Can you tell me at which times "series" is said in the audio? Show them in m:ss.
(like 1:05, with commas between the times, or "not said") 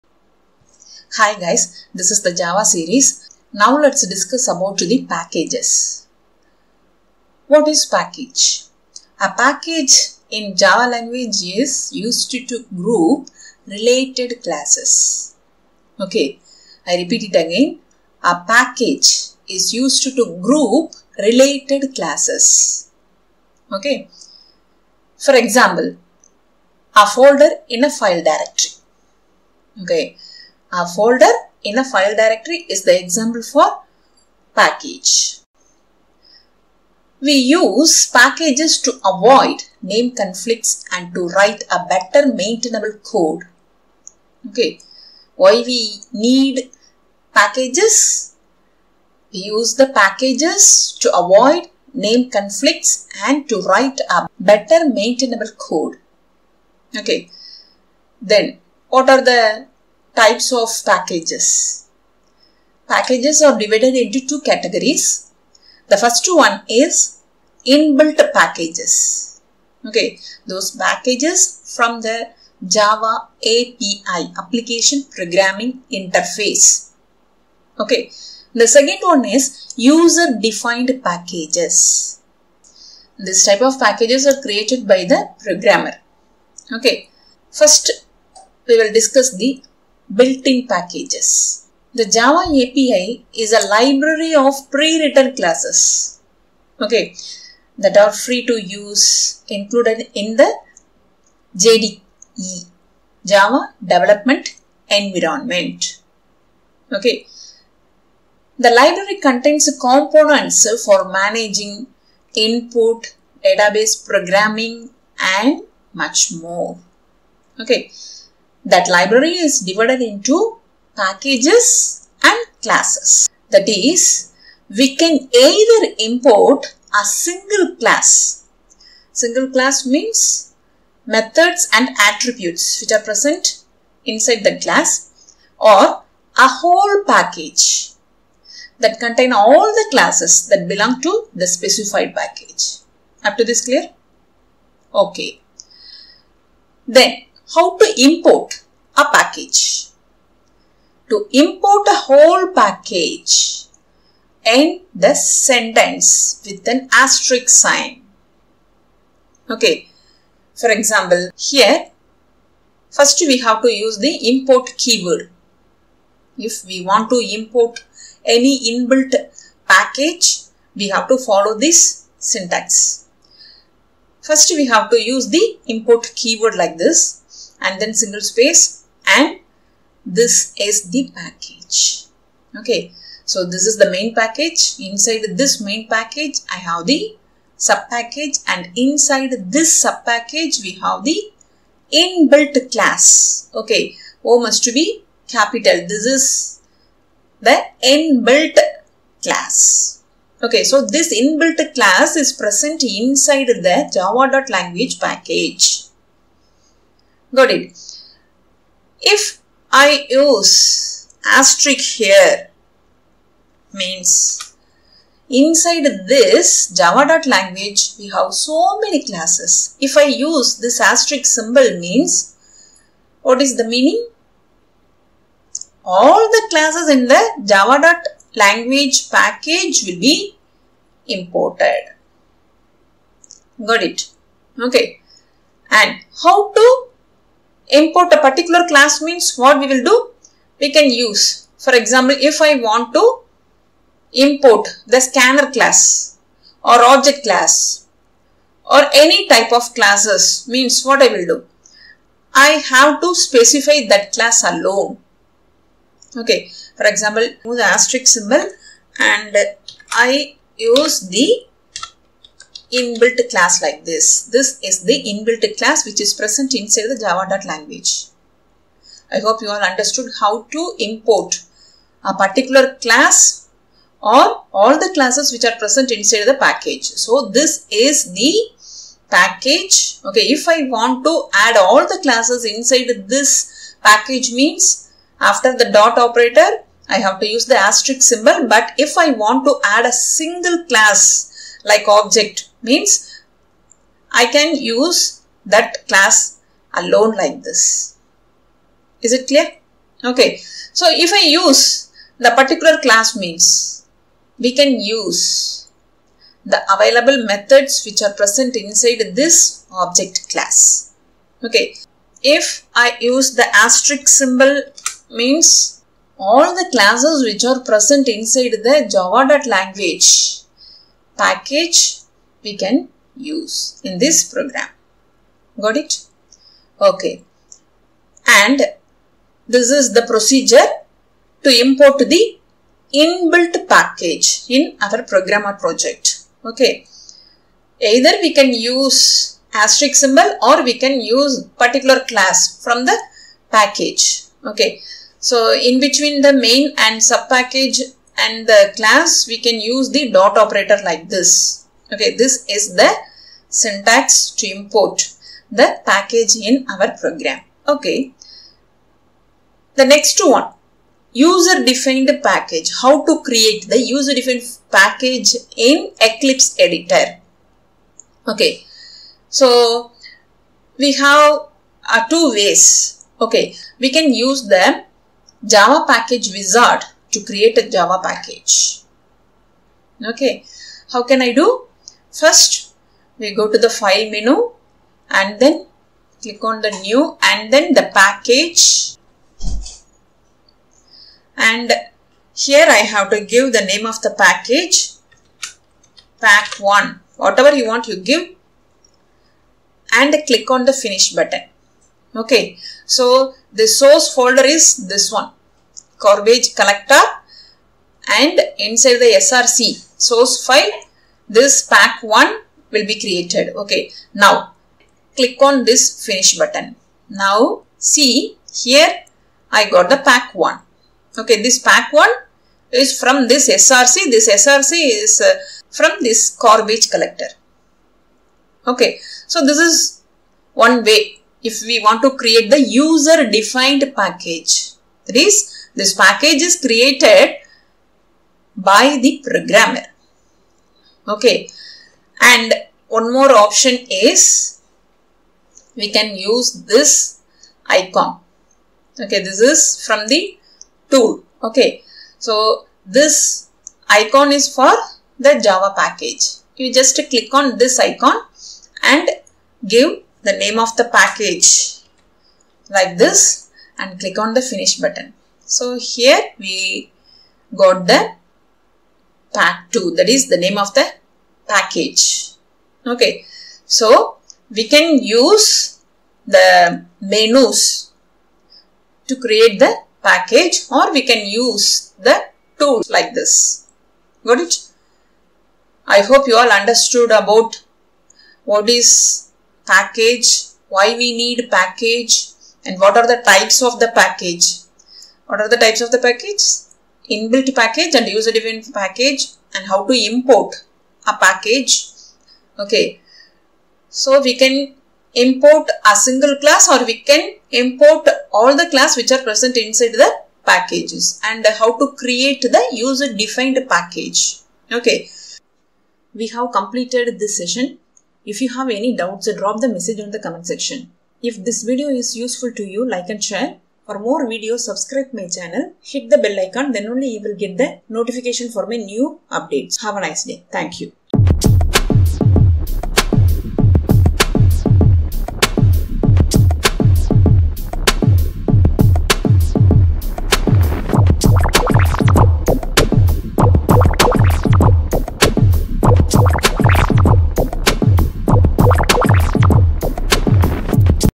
0:02.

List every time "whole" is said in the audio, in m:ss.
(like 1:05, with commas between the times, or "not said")
2:16, 2:31.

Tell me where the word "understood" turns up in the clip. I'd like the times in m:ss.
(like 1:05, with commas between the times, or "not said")
4:29, 8:06.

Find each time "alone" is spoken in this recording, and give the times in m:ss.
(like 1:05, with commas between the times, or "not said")
4:14, 4:56.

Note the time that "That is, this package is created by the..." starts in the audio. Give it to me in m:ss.
7:15.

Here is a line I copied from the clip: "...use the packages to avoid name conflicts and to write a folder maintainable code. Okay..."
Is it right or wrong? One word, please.
wrong.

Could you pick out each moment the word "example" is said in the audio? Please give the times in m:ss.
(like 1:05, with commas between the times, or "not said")
0:25, 0:32, 2:40, 4:01, 4:16.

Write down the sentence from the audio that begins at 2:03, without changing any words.
That is, we can either import a single class.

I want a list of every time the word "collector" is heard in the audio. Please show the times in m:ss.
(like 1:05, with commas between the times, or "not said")
6:46, 7:06.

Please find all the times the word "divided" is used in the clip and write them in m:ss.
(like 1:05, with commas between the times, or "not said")
1:03, 1:59.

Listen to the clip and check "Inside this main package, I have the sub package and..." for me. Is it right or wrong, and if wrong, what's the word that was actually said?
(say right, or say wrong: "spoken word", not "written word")
right.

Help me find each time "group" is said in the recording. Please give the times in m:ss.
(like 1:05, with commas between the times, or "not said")
0:12, 0:20.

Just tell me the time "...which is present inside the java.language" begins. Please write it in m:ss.
4:25.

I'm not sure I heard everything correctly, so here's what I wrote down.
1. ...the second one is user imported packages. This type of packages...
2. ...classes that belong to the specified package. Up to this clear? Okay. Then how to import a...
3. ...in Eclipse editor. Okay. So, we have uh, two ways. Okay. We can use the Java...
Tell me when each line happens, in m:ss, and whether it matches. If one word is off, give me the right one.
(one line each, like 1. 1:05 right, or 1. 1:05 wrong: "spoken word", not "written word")
1. 1:18 wrong: "defined", not "imported"
2. 2:19 right
3. 6:05 right.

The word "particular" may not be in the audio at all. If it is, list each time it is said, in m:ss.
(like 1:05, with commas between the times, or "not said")
3:58, 4:32, 5:02, 5:41.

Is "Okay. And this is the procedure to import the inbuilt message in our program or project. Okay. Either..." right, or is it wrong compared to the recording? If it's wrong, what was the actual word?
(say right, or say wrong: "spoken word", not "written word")
wrong: "package", not "message".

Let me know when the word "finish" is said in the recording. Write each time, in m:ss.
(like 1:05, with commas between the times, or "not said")
6:40, 6:56, 7:44.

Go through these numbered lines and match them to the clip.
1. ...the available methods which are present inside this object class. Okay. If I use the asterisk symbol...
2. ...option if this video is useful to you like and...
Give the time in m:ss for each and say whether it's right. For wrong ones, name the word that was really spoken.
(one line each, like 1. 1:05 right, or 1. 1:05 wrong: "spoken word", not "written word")
1. 5:06 right
2. 8:40 wrong: "section", not "option".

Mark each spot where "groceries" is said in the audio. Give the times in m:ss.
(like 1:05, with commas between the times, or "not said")
not said.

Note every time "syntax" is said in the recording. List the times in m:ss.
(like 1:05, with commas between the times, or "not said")
2:52, 5:53.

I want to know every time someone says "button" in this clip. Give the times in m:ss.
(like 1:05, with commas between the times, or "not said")
6:41, 6:56, 7:44.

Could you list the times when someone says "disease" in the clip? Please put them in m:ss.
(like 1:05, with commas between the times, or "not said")
not said.